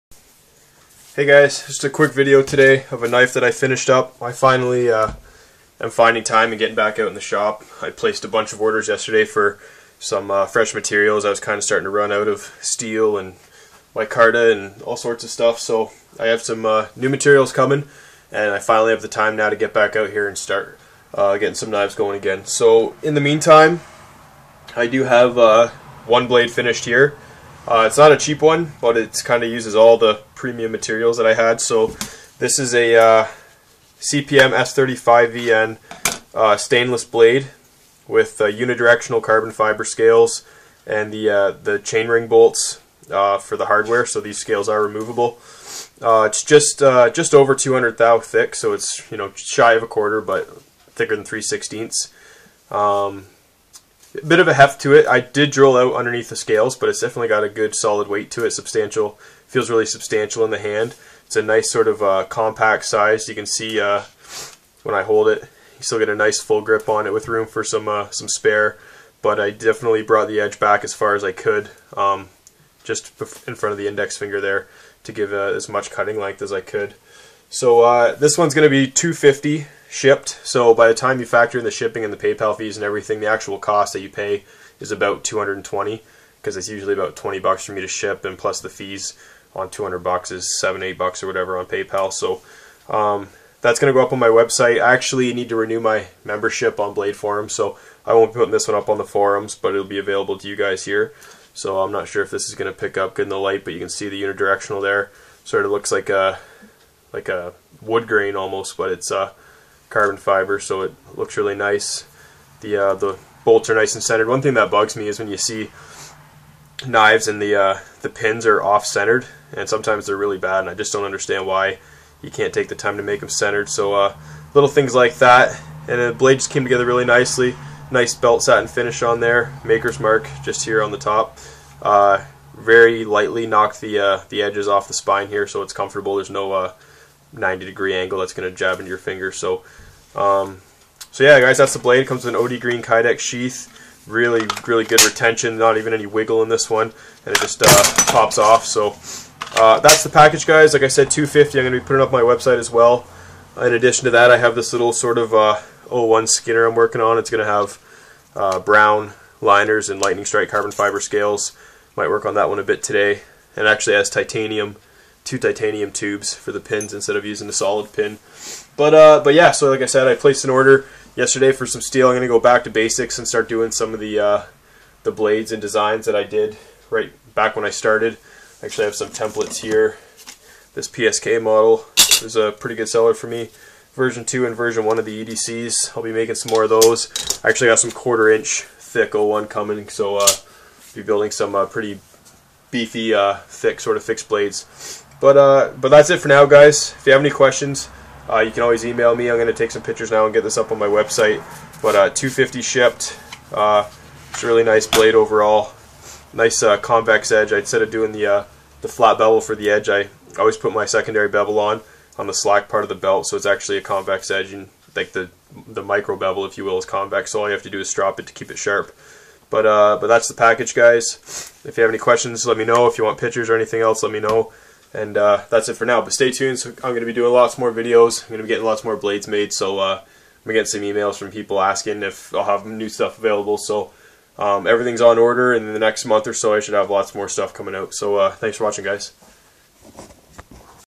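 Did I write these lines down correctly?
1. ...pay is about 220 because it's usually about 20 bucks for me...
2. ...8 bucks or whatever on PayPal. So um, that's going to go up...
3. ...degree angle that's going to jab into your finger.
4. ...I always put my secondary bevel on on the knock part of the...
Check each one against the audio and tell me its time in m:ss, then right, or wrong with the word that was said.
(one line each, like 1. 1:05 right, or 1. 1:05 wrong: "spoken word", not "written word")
1. 1:24 right
2. 1:30 right
3. 2:17 right
4. 3:29 wrong: "slack", not "knock".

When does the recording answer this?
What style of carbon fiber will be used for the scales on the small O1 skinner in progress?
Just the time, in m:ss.
2:40.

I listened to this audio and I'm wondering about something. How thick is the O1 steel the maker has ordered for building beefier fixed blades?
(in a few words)
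Quarter inch.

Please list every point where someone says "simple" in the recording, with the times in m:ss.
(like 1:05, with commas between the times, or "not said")
not said.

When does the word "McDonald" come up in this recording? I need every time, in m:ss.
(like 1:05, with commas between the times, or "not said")
not said.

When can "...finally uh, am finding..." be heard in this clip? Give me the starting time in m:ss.
0:04.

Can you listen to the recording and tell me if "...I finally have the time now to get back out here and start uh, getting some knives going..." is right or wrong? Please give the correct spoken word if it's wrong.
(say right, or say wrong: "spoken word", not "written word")
right.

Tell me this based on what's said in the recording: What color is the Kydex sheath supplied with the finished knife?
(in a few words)
OD green.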